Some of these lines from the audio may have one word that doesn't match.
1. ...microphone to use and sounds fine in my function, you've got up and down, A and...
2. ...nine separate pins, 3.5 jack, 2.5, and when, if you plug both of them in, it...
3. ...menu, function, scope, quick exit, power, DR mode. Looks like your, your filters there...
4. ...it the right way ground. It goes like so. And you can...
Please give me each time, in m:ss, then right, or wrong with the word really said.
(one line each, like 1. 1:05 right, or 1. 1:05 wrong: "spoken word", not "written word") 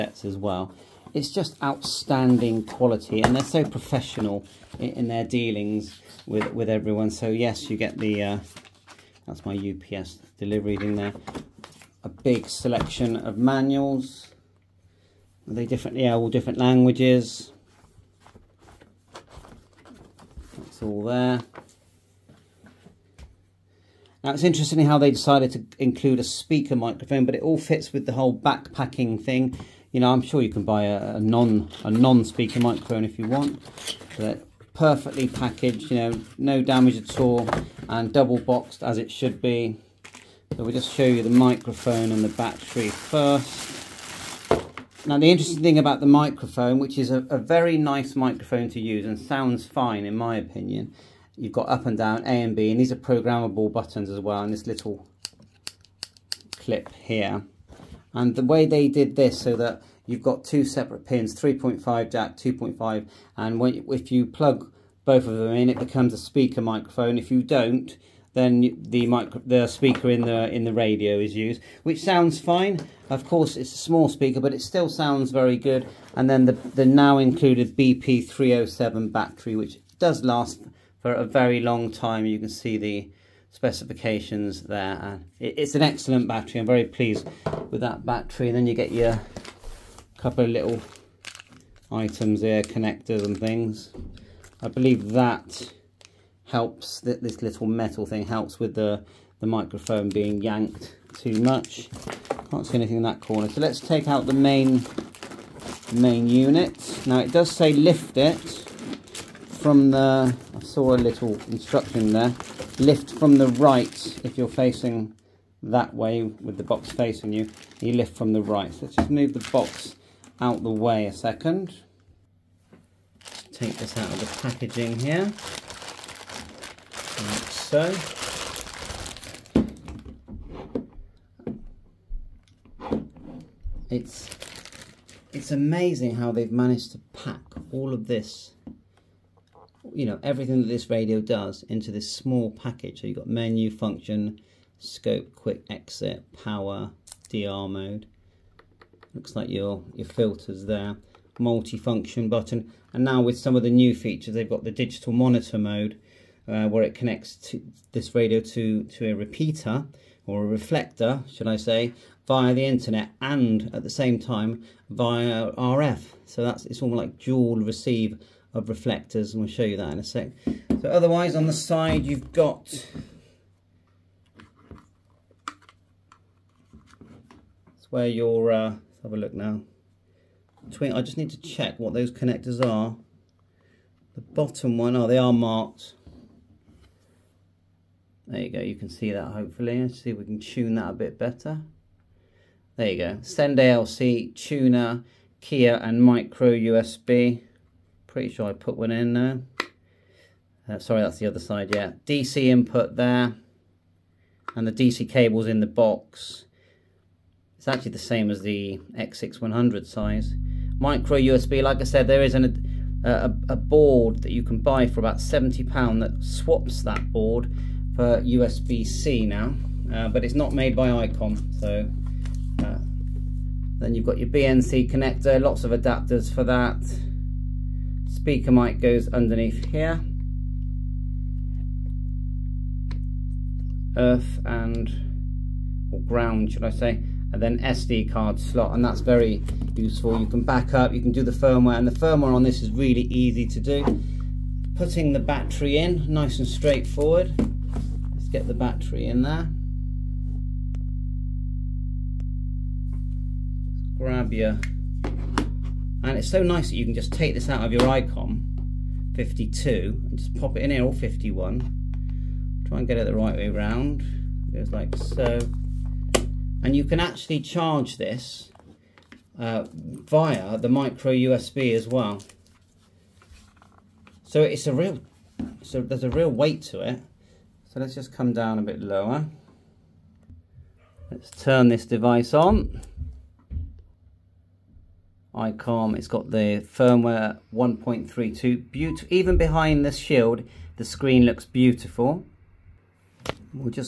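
1. 0:48 wrong: "opinion", not "function"
2. 1:00 wrong: "two", not "nine"
3. 2:23 right
4. 4:22 wrong: "round", not "ground".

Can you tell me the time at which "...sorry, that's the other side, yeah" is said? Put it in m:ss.
3:20.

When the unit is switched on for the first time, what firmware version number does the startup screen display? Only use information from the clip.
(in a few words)
1.32.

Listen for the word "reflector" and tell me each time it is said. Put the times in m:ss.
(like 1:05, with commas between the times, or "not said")
2:40, 2:48.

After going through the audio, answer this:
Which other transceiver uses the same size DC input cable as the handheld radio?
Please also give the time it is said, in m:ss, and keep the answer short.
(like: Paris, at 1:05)
X6100, at 3:28.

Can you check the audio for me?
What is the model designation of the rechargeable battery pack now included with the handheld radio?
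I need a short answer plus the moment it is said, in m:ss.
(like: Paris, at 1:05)
BP307, at 1:17.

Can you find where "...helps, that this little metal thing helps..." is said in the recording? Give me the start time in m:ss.
1:36.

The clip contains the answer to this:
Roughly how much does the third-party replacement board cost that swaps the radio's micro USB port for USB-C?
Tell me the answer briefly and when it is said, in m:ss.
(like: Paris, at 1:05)
£70, at 3:35.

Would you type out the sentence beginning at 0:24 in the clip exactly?
Now it's interesting how they decided to include a speaker microphone, but it all fits with the whole backpacking thing.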